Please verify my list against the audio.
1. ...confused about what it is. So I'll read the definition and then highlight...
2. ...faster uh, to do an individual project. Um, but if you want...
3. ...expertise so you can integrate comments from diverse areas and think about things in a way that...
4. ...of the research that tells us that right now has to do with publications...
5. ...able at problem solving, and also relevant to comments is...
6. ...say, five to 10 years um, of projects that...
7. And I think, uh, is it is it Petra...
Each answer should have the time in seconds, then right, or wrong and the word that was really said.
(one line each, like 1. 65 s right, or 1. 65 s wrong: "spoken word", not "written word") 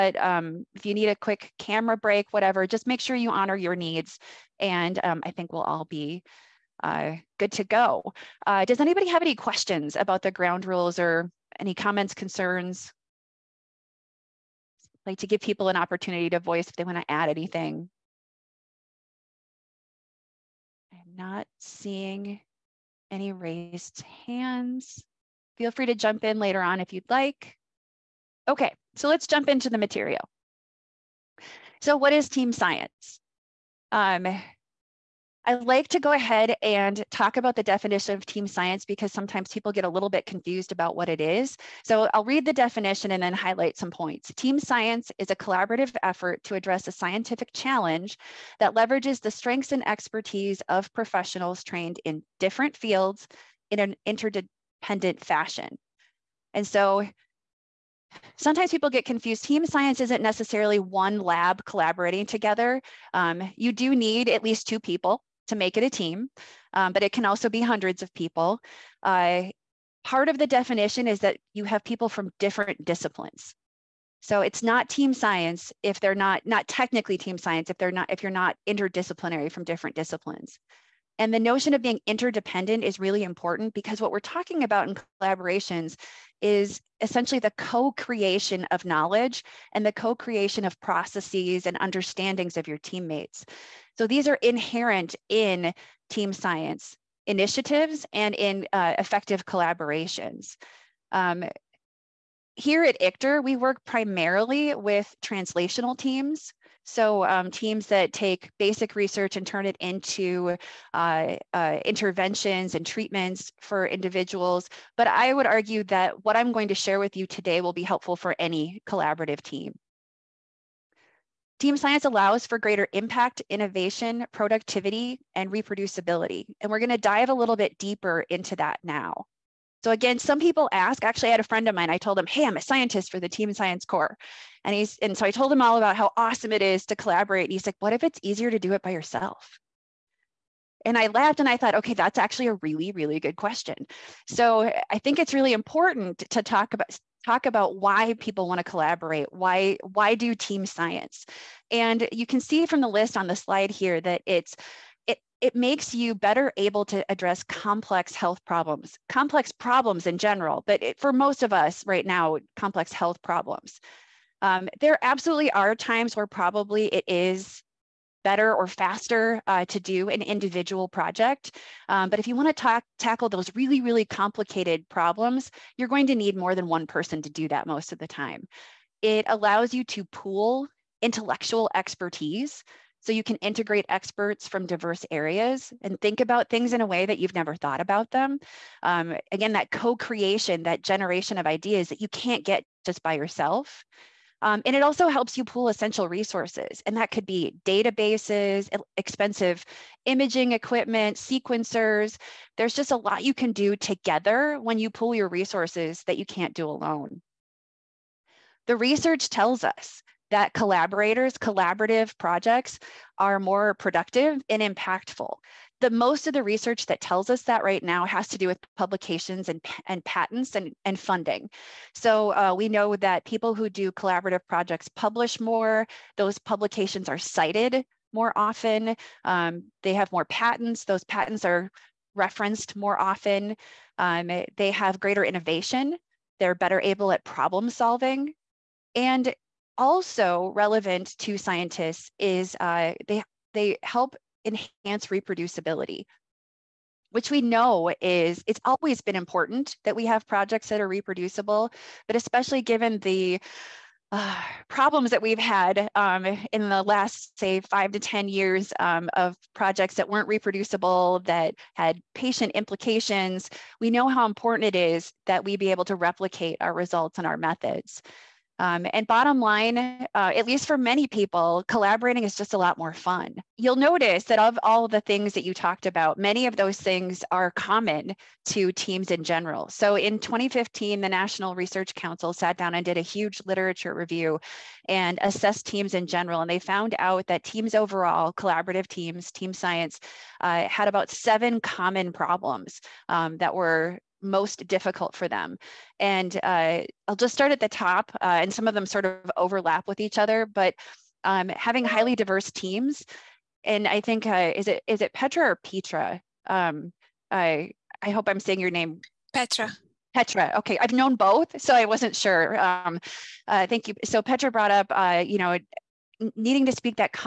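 1. 40 s right
2. 168 s right
3. 181 s wrong: "experts", not "comments"
4. 216 s right
5. 236 s wrong: "scientists", not "comments"
6. 257 s right
7. 303 s right.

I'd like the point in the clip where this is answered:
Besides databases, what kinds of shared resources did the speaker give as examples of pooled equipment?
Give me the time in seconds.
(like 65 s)
198 s.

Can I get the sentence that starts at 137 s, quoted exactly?
And he's like, what if it's easier to do it by yourself?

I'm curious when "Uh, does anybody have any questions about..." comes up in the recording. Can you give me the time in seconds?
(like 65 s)
8 s.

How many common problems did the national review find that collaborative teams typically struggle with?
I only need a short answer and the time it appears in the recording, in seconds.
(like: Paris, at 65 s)
7, at 291 s.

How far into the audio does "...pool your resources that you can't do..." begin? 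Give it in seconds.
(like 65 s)
204 s.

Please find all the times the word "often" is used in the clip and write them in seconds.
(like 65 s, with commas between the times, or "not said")
228 s, 232 s.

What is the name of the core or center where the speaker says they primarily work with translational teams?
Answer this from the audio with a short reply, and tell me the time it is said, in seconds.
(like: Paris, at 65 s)
ICTR, at 102 s.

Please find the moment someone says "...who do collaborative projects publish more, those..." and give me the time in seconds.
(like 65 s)
223 s.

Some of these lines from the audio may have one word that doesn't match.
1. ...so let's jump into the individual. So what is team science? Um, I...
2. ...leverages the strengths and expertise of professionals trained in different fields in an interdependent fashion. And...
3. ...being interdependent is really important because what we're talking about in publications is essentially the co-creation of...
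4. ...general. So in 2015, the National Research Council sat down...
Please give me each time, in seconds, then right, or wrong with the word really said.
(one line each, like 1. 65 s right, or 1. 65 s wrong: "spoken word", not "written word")
1. 28 s wrong: "material", not "individual"
2. 48 s right
3. 81 s wrong: "collaborations", not "publications"
4. 279 s right.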